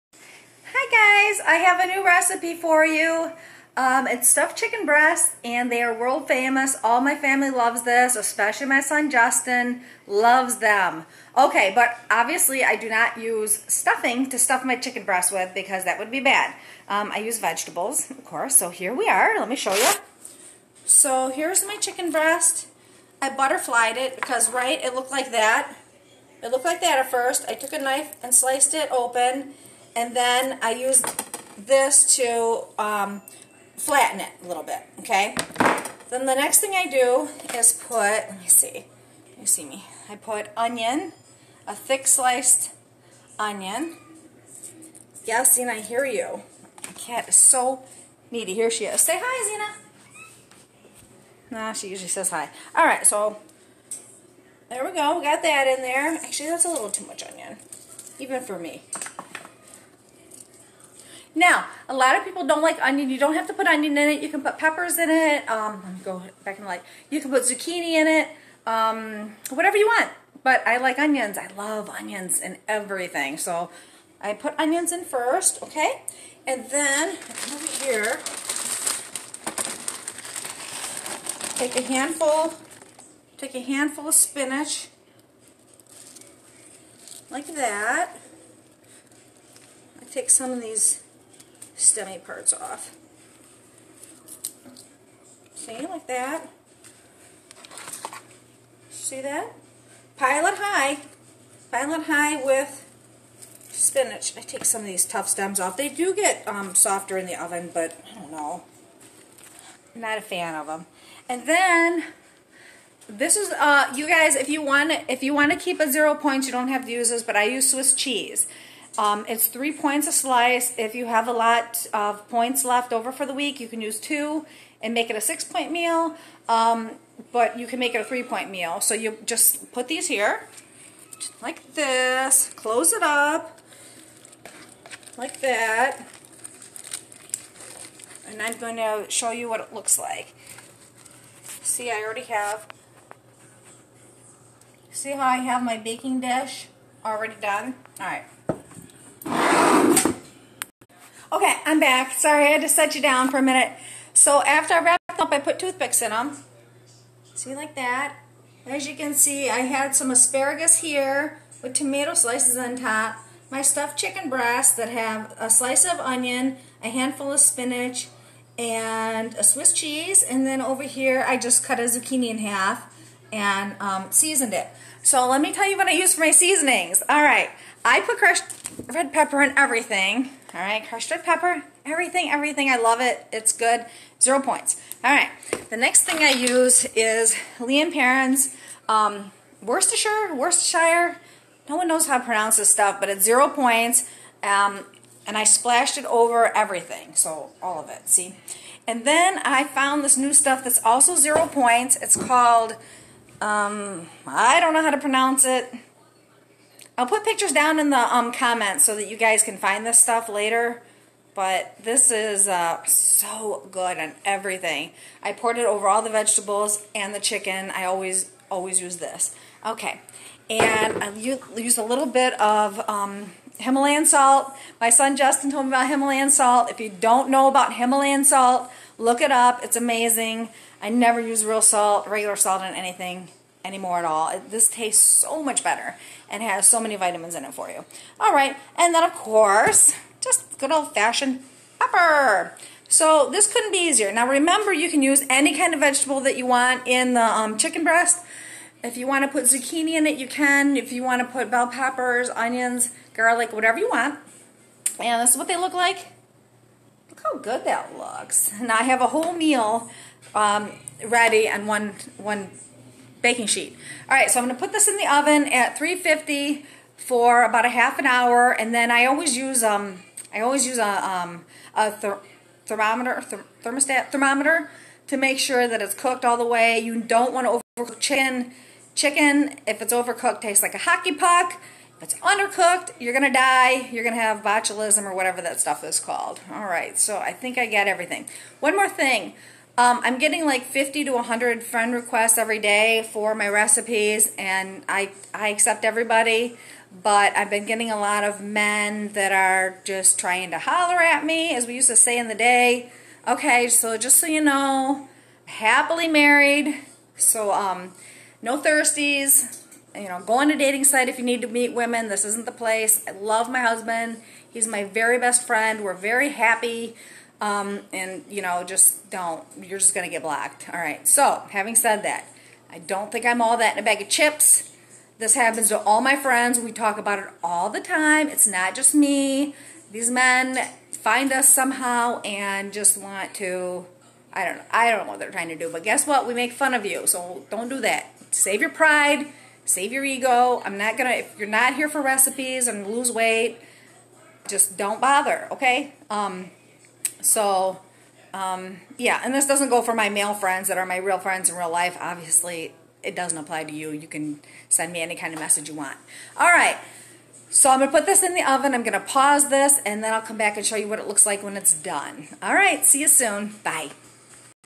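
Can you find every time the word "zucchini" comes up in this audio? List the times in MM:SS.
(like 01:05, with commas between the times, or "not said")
01:07, 02:51, 04:09.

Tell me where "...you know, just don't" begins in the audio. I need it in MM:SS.
05:18.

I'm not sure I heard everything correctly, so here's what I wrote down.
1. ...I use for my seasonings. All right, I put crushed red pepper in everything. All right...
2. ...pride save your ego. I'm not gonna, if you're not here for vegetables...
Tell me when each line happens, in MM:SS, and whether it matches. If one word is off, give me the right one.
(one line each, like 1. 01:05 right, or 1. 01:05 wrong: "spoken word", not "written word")
1. 02:55 right
2. 05:38 wrong: "recipes", not "vegetables".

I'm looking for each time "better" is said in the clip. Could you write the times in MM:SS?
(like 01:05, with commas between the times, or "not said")
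03:55.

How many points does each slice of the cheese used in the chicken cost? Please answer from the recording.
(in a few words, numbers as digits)
3 points.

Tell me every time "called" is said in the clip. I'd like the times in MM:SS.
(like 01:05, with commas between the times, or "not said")
03:22, 04:45.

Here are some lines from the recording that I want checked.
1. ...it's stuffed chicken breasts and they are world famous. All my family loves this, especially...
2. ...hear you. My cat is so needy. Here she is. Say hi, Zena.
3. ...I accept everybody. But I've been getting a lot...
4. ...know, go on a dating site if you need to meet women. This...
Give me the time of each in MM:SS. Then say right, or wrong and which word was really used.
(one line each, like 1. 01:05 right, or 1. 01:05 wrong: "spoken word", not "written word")
1. 00:04 right
2. 00:45 right
3. 04:55 right
4. 05:10 right.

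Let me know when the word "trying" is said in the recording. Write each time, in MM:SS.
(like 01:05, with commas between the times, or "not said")
05:00, 05:35.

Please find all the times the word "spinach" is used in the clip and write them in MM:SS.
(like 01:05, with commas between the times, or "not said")
01:24, 01:43, 02:47.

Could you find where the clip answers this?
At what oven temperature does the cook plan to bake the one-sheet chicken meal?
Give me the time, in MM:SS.
04:25.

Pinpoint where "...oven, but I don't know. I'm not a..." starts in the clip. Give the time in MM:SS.
01:47.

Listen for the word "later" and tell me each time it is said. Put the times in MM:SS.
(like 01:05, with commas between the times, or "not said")
03:30.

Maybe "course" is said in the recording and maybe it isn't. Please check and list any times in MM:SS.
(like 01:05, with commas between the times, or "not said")
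00:18, 03:59.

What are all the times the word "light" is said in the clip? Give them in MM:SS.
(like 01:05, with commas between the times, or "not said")
01:06.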